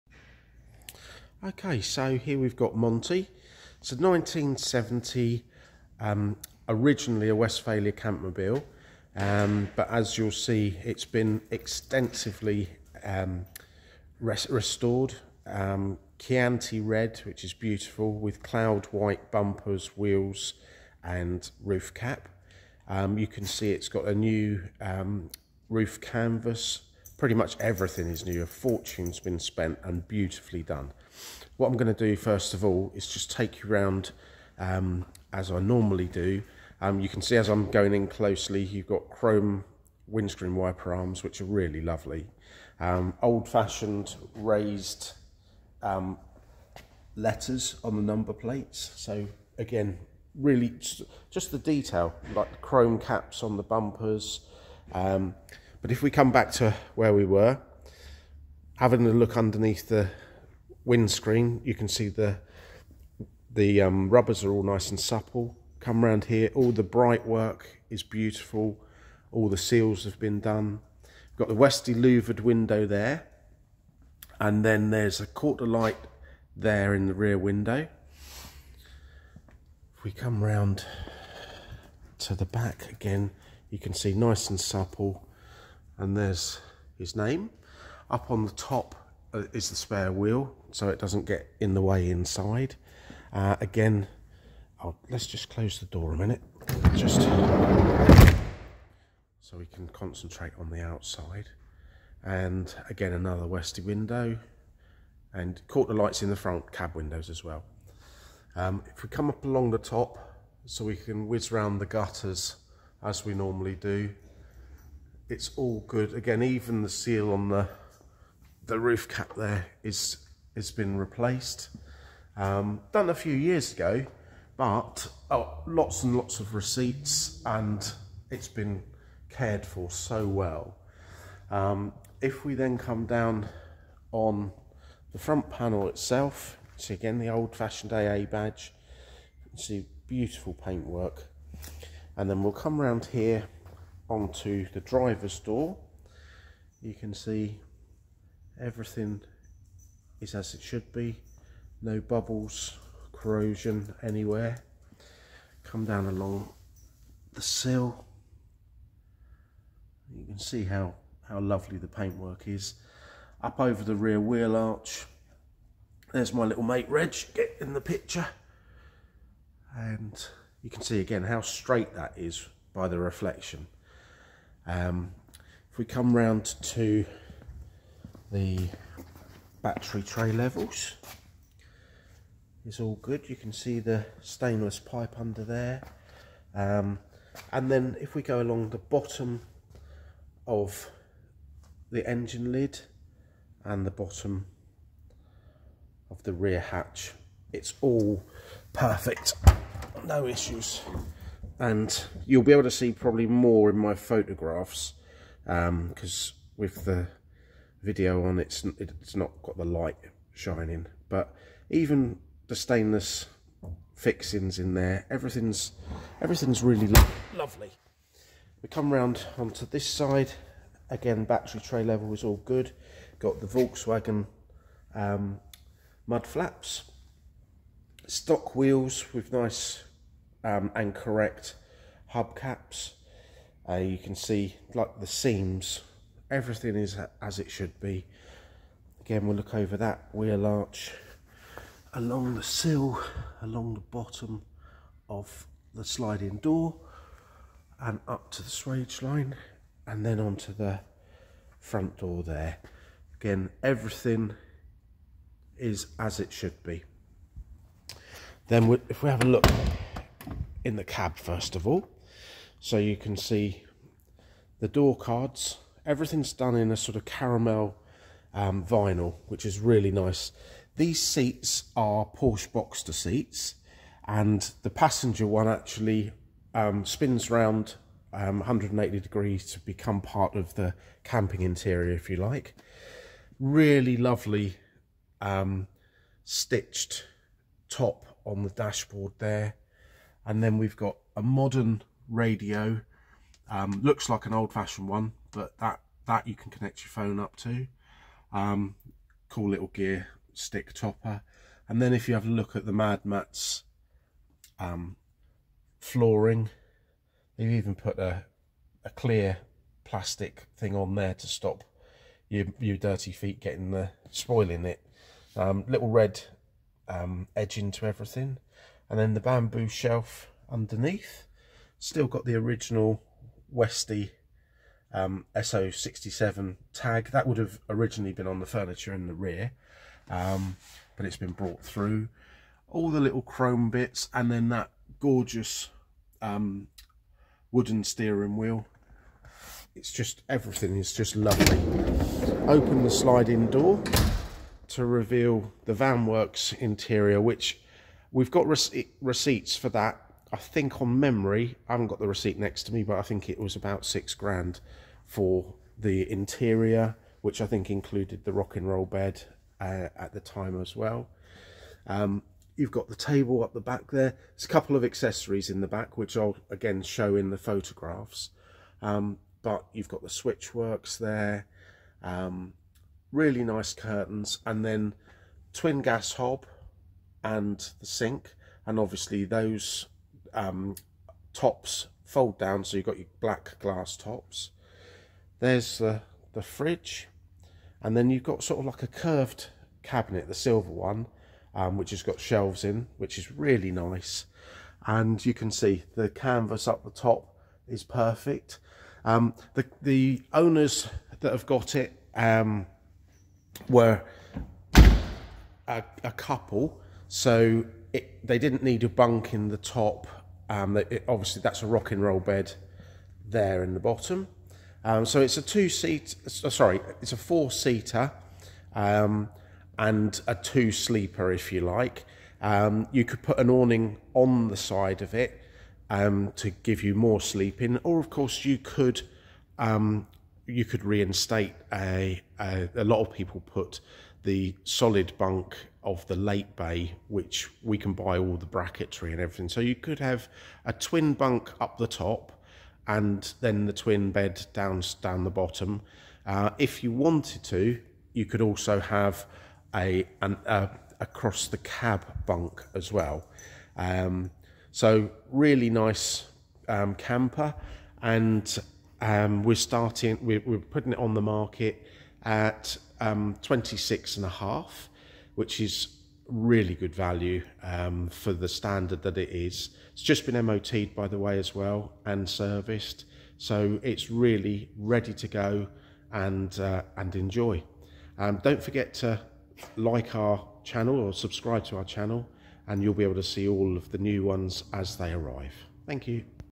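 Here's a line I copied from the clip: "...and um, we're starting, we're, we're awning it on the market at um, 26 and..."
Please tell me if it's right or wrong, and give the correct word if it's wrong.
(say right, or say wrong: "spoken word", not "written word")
wrong: "putting", not "awning".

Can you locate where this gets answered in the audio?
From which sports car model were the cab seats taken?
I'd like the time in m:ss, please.
4:32.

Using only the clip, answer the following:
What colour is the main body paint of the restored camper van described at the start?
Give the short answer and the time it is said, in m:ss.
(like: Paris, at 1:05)
Chianti red, at 0:16.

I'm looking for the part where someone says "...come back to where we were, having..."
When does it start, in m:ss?
0:56.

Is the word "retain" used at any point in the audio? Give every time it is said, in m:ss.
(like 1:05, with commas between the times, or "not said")
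not said.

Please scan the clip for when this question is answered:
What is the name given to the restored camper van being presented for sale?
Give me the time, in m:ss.
0:02.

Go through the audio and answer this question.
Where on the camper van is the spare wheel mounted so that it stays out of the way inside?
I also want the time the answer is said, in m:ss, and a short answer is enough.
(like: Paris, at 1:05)
Up on the top, at 1:28.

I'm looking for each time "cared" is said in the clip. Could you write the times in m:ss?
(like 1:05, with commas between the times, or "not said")
2:09.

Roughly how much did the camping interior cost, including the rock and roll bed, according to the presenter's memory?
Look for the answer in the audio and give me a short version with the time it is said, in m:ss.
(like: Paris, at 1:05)
about six grand, at 5:53.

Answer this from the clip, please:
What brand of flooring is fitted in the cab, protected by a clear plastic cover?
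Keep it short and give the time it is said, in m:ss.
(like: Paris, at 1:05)
Mad Mats, at 5:02.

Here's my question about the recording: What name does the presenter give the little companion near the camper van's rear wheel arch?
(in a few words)
Reg.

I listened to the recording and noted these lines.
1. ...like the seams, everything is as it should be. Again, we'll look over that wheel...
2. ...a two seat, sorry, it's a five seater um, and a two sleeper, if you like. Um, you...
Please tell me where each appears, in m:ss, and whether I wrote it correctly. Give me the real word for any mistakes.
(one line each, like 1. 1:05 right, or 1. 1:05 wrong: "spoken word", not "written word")
1. 3:54 right
2. 6:55 wrong: "four", not "five".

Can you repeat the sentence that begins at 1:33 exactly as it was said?
Uh, again, I'll, let's just close the door a minute, just so we can concentrate on the outside.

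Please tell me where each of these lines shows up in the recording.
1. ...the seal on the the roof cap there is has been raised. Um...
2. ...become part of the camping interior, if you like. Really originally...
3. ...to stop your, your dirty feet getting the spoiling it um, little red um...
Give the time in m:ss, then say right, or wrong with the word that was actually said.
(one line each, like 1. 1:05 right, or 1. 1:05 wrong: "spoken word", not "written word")
1. 1:56 wrong: "replaced", not "raised"
2. 4:39 wrong: "lovely", not "originally"
3. 5:11 right.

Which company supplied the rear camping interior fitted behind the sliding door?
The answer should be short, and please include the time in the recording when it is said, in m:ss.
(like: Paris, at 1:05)
Vanwurks, at 5:45.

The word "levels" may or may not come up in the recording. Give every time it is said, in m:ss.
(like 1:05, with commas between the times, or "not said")
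3:00, 3:41.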